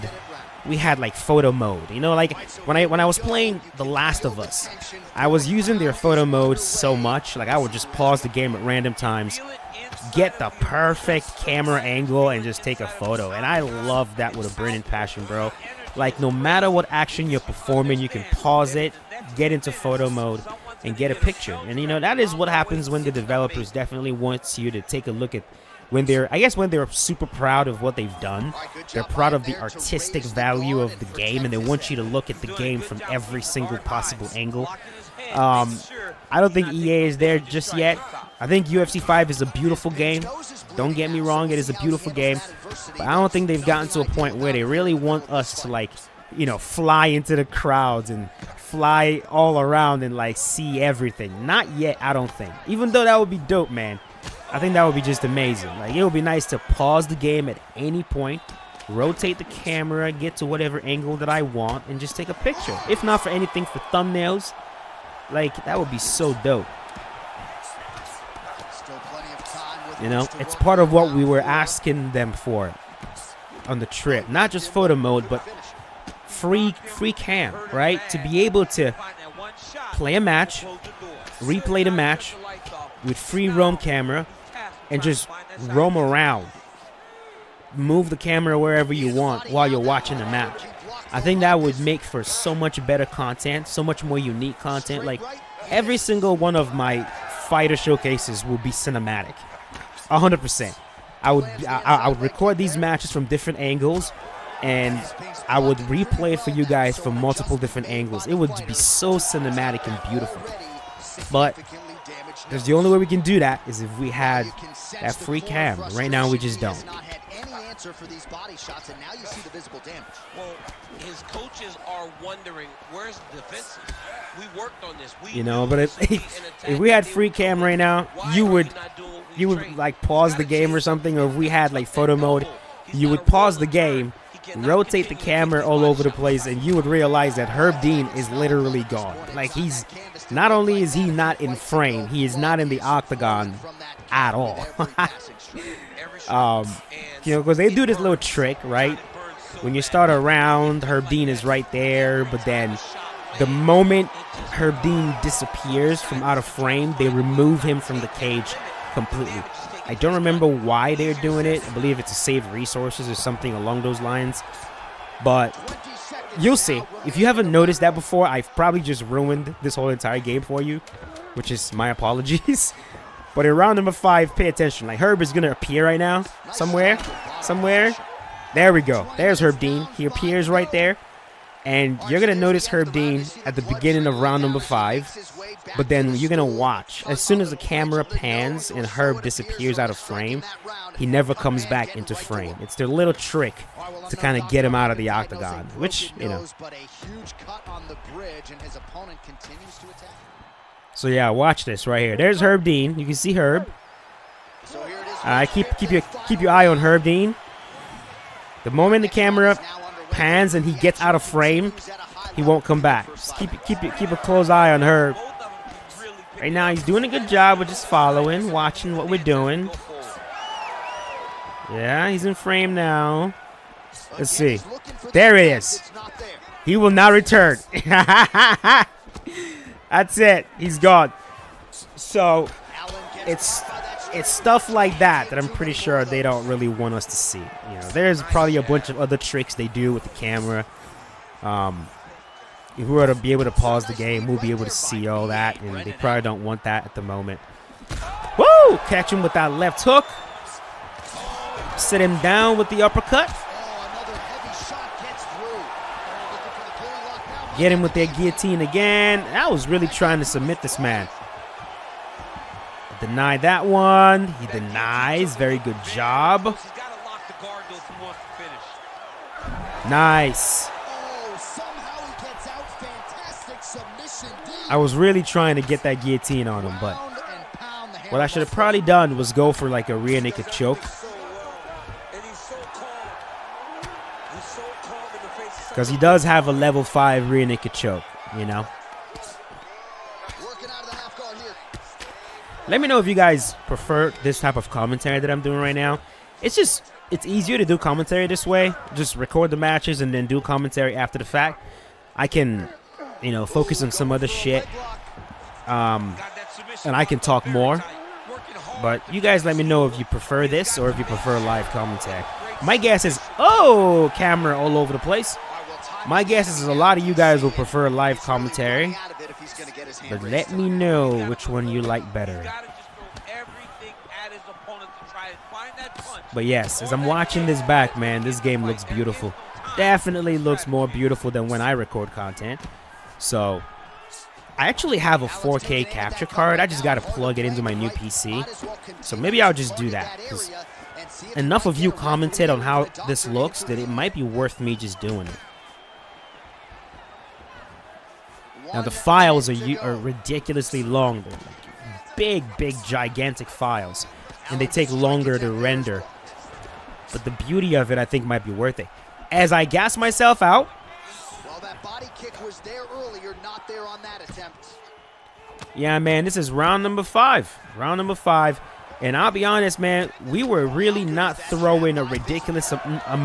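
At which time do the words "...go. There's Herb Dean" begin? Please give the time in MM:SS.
02:58.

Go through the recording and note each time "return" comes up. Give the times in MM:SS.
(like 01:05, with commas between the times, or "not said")
03:47.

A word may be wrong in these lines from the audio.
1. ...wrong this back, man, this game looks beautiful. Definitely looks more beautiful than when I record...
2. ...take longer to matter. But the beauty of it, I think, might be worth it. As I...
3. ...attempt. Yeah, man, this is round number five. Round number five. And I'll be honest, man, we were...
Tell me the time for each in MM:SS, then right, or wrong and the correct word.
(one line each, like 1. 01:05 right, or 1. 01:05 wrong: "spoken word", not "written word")
1. 05:27 wrong: "watching", not "wrong"
2. 05:54 wrong: "render", not "matter"
3. 06:04 right.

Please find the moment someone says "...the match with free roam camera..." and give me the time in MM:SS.
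01:21.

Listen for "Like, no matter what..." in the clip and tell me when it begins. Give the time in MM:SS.
00:15.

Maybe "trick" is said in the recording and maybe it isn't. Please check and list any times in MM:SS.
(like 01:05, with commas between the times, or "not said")
02:28, 03:13, 03:59.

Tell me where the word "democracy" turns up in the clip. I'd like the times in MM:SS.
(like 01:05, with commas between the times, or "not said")
not said.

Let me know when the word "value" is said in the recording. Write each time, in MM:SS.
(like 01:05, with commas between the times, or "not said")
00:30.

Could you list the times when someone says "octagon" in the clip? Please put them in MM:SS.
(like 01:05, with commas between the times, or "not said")
02:22, 03:15.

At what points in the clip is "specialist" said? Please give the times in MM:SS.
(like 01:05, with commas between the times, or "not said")
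not said.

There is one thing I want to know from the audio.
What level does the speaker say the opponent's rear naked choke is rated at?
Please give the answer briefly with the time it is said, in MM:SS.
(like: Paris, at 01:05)
5, at 04:46.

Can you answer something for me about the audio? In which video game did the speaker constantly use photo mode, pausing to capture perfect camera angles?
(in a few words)
The Last of Us.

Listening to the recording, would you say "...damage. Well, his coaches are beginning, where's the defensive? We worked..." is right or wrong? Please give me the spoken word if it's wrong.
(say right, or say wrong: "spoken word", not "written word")
wrong: "wondering", not "beginning".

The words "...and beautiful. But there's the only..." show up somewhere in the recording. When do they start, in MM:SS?
01:49.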